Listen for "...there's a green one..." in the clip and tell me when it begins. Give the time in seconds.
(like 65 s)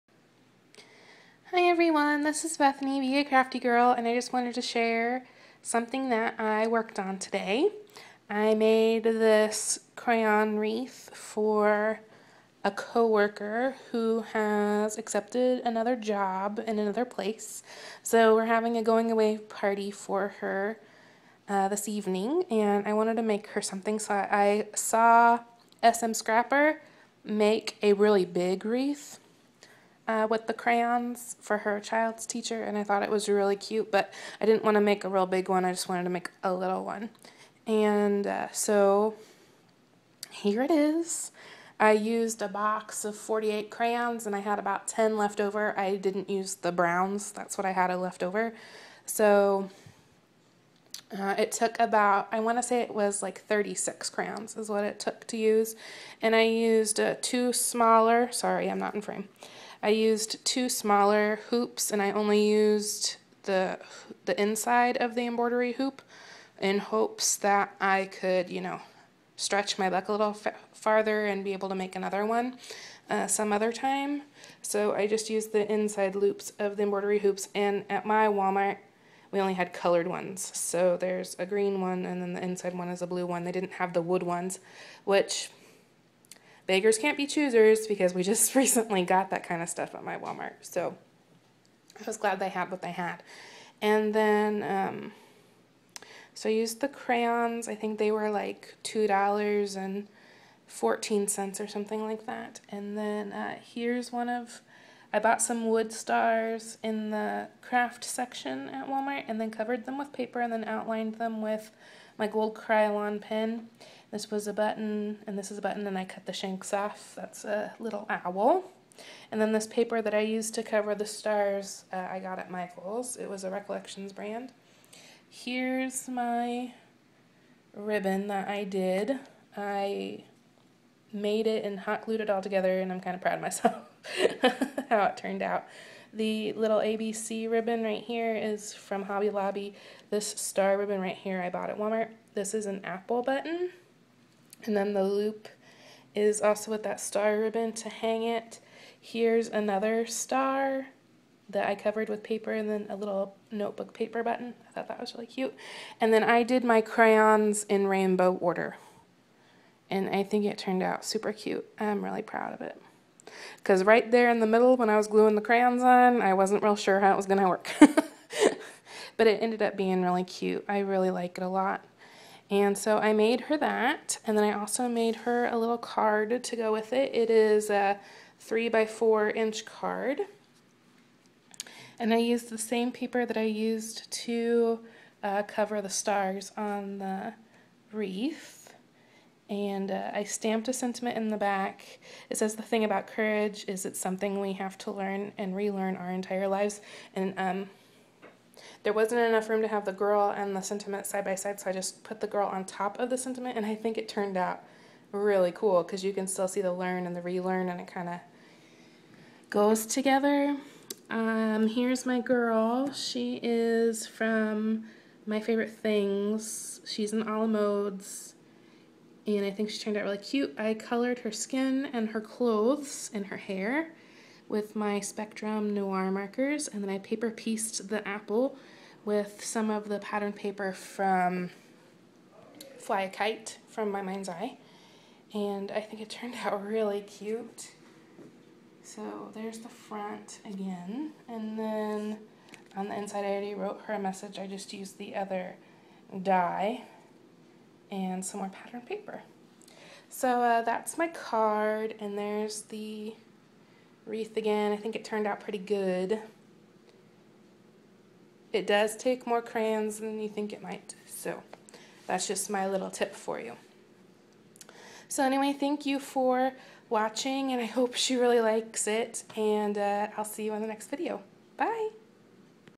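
80 s.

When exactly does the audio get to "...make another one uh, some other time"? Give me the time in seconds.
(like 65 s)
71 s.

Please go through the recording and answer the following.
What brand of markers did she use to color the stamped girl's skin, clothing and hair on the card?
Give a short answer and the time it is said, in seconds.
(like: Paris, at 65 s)
Spectrum Noir, at 224 s.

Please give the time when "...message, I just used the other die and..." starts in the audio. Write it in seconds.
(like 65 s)
243 s.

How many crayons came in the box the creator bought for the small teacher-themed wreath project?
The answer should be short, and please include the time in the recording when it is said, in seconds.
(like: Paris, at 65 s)
48, at 43 s.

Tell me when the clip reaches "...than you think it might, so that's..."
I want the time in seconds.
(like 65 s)
259 s.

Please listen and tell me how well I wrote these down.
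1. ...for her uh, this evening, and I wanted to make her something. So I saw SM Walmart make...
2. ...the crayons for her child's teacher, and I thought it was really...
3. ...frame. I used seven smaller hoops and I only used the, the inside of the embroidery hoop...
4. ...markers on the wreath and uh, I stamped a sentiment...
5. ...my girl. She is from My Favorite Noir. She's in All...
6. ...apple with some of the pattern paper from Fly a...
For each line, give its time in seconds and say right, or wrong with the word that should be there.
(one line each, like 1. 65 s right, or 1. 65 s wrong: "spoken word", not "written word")
1. 19 s wrong: "Scrapper", not "Walmart"
2. 30 s right
3. 59 s wrong: "two", not "seven"
4. 185 s wrong: "stars", not "markers"
5. 212 s wrong: "Things", not "Noir"
6. 228 s right.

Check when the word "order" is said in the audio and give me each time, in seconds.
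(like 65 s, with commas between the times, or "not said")
158 s.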